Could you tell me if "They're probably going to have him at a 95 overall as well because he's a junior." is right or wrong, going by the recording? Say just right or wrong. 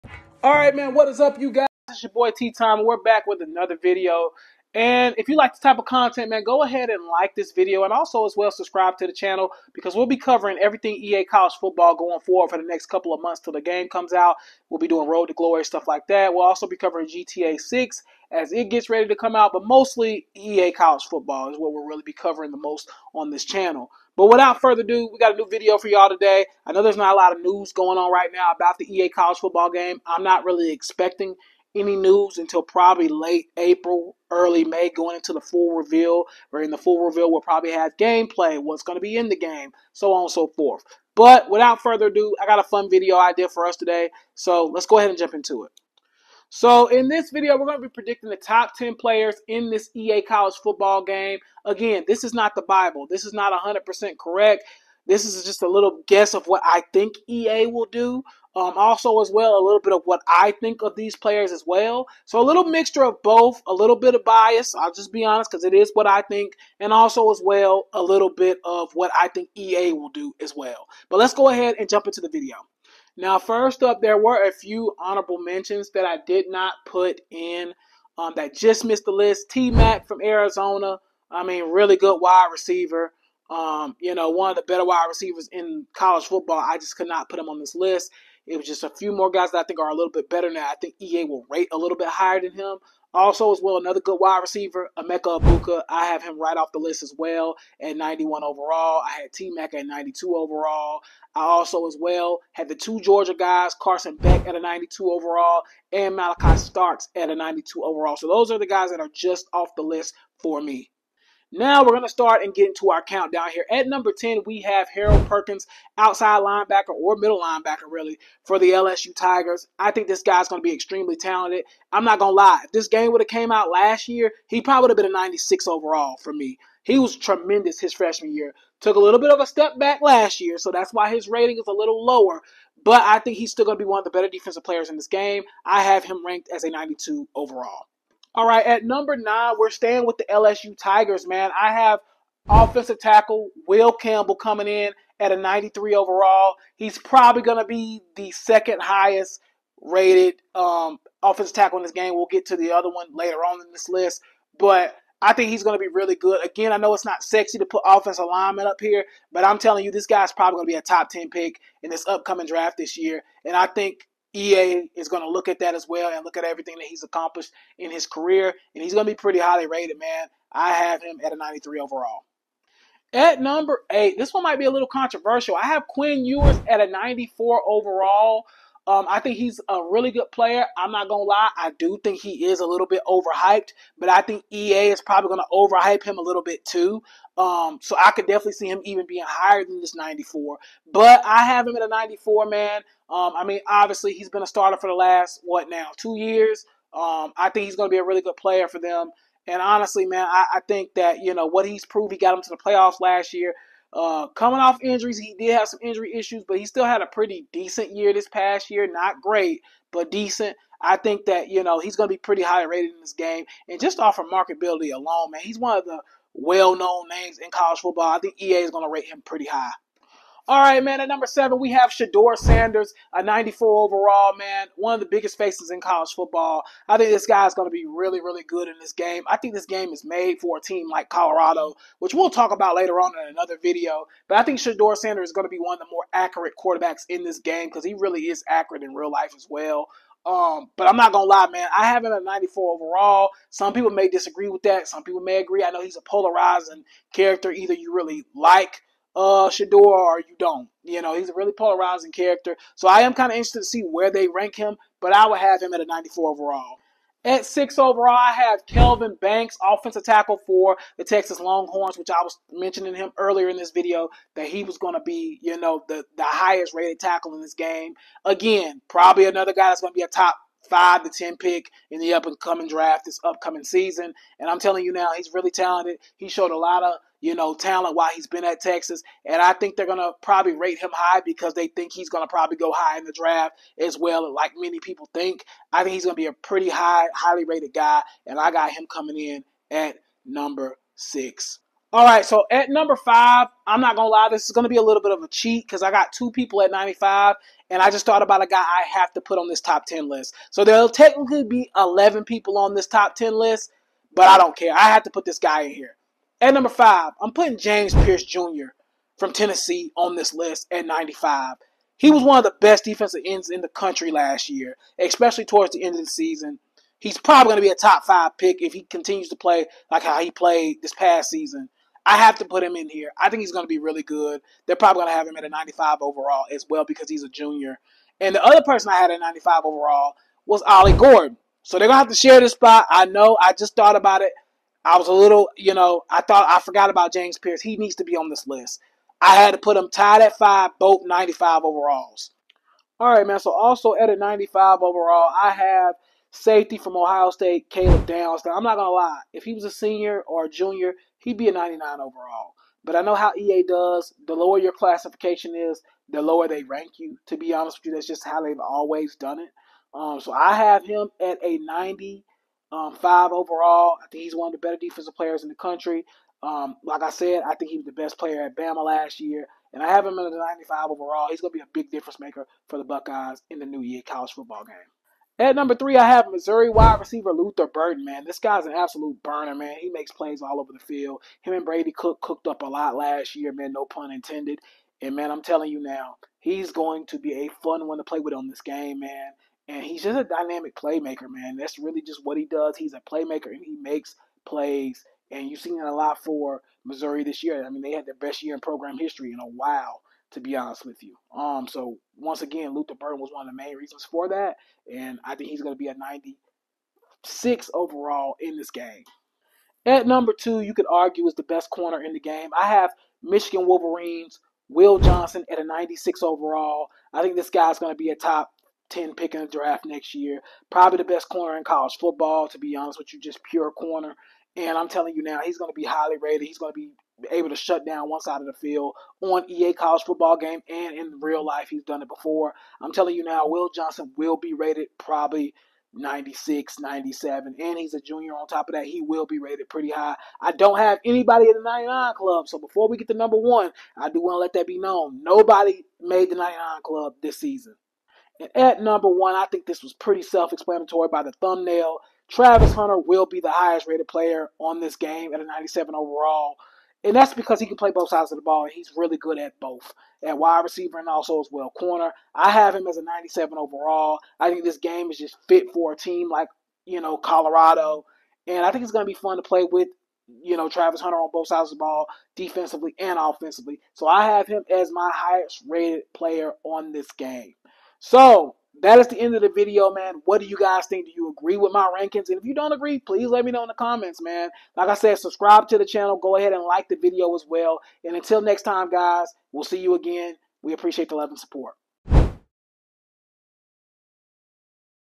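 right.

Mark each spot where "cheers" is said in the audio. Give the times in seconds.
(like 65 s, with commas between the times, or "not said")
not said.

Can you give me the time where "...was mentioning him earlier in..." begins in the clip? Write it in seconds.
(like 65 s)
262 s.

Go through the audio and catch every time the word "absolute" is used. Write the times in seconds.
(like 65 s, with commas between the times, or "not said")
378 s.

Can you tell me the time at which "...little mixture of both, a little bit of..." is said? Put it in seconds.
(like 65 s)
62 s.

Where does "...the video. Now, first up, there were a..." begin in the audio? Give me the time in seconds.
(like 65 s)
72 s.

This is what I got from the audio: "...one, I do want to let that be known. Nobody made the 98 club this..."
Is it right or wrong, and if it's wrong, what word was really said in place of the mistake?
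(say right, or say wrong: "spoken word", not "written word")
wrong: "99", not "98".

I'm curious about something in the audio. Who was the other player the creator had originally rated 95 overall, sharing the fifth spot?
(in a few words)
Ollie Gordon.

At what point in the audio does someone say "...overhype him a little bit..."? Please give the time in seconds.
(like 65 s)
185 s.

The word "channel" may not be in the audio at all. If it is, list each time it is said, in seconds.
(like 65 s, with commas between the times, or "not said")
9 s, 23 s, 485 s.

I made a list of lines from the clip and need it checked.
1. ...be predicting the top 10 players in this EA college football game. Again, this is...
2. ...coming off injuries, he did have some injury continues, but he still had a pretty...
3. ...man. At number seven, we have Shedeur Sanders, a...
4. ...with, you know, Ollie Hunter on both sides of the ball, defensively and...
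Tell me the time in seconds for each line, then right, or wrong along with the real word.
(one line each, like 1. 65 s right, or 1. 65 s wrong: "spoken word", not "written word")
1. 47 s right
2. 204 s wrong: "issues", not "continues"
3. 220 s right
4. 469 s wrong: "Travis", not "Ollie".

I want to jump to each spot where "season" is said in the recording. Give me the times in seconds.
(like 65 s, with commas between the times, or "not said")
273 s, 316 s, 321 s, 447 s.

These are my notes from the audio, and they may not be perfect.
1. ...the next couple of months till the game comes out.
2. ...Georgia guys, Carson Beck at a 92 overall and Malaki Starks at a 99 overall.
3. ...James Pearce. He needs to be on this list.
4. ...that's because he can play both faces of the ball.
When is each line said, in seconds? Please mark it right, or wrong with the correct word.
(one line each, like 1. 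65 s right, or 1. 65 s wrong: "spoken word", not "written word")
1. 12 s right
2. 102 s wrong: "92", not "99"
3. 337 s right
4. 457 s wrong: "sides", not "faces".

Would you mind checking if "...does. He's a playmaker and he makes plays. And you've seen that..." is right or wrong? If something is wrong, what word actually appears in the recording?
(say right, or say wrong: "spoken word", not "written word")
right.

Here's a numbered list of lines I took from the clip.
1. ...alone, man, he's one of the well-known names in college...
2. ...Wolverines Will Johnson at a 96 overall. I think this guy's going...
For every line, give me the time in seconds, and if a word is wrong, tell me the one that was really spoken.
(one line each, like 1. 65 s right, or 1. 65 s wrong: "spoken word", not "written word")
1. 214 s right
2. 413 s right.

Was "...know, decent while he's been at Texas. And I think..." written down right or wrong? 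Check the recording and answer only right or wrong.
wrong.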